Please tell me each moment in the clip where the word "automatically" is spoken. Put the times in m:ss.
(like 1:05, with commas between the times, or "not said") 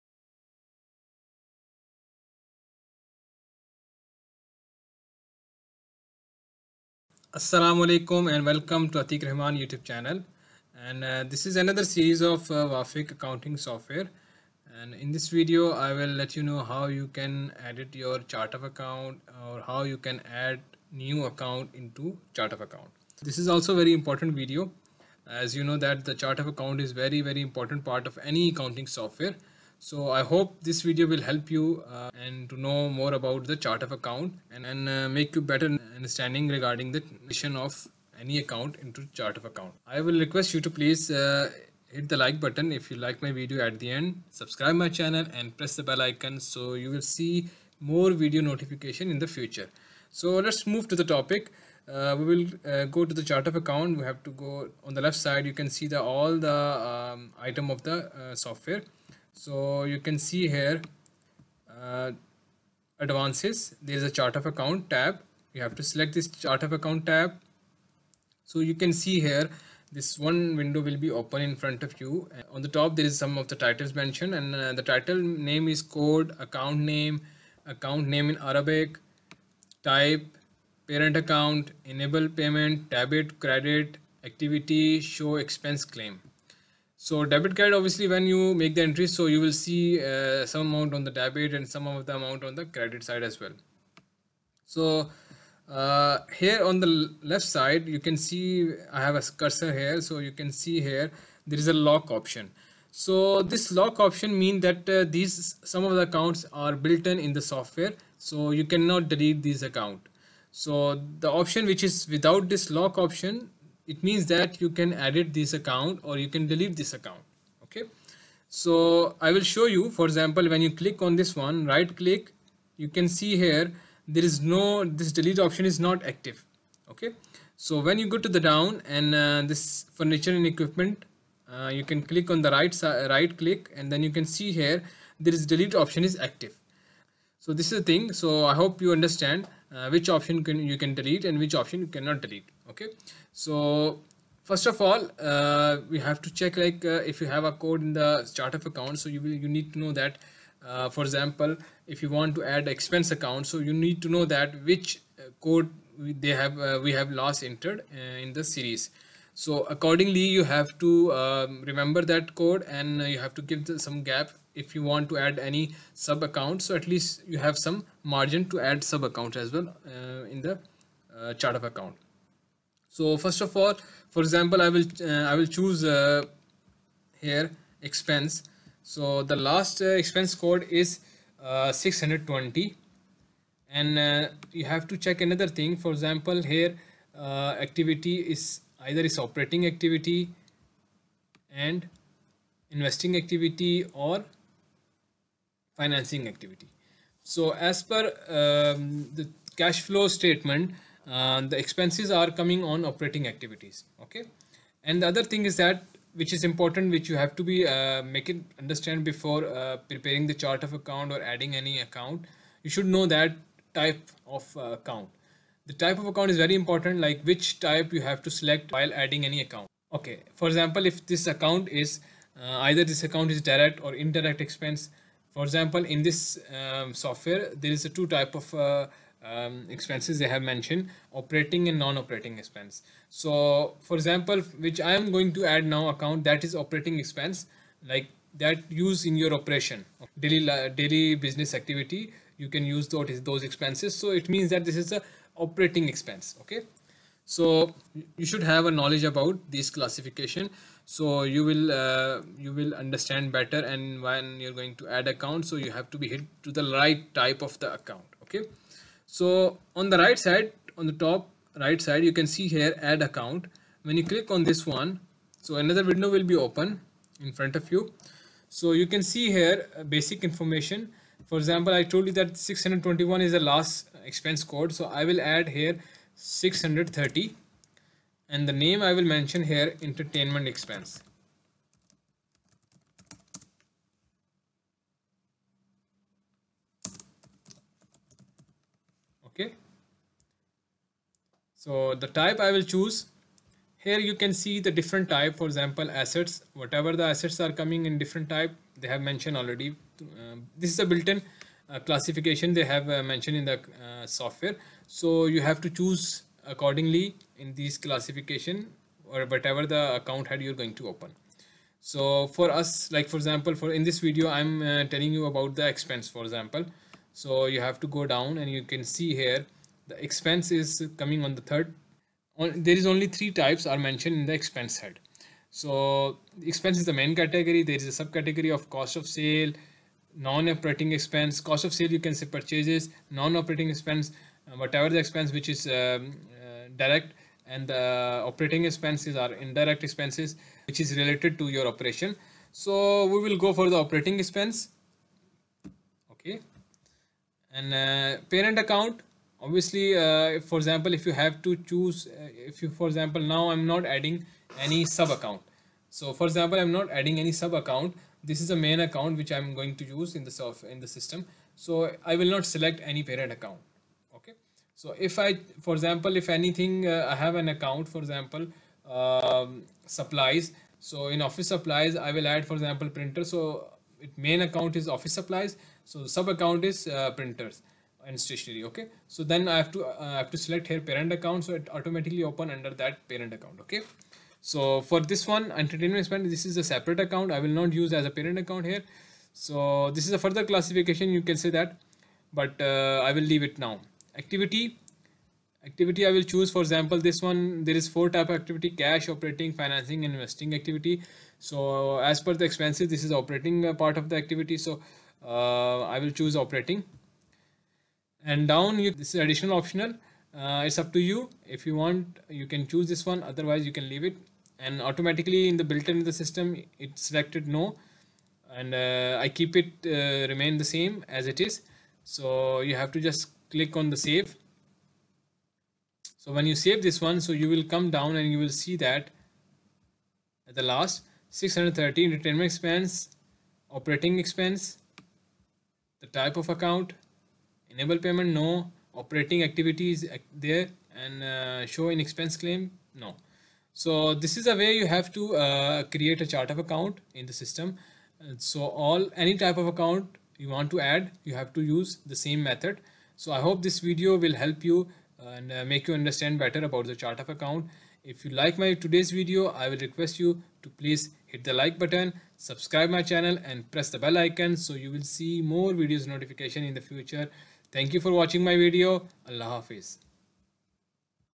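6:21, 6:54.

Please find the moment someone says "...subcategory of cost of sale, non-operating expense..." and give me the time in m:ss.
5:28.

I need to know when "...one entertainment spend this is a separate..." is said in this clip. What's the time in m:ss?
6:25.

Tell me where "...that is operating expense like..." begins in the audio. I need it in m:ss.
3:56.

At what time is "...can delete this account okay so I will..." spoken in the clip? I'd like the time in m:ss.
1:56.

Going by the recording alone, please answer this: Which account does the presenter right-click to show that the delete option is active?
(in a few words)
furniture and equipment.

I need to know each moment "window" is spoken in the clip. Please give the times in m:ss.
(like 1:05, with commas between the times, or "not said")
1:10, 4:25.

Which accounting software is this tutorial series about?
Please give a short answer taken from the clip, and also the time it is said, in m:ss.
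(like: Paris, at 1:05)
Wafeq, at 0:12.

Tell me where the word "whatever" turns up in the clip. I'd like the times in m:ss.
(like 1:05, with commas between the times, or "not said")
4:56, 5:09, 5:34.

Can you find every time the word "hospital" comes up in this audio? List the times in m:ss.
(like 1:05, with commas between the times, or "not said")
not said.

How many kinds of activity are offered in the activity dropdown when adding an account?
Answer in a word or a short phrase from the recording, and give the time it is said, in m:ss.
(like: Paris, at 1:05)
4, at 6:37.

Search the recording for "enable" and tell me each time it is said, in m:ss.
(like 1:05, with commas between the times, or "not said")
1:21, 7:17.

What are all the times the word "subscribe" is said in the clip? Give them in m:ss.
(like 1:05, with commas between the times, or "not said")
0:44, 7:42.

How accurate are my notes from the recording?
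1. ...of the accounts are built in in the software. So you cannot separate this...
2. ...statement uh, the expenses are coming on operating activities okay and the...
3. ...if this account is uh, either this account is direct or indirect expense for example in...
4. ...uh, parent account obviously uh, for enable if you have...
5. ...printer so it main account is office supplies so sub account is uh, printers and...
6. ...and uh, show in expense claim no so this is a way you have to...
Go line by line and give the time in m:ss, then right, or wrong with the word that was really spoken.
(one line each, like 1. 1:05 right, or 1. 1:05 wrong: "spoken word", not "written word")
1. 1:45 wrong: "delete", not "separate"
2. 3:20 right
3. 3:40 right
4. 5:47 wrong: "example", not "enable"
5. 6:12 right
6. 7:21 right.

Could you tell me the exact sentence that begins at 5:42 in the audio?
So we will go for the operating expense.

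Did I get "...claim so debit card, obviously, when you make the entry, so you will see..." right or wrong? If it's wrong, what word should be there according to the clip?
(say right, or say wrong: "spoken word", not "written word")
right.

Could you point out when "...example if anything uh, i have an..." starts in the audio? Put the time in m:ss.
6:05.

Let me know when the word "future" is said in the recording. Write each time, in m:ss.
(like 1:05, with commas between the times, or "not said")
0:49, 7:46.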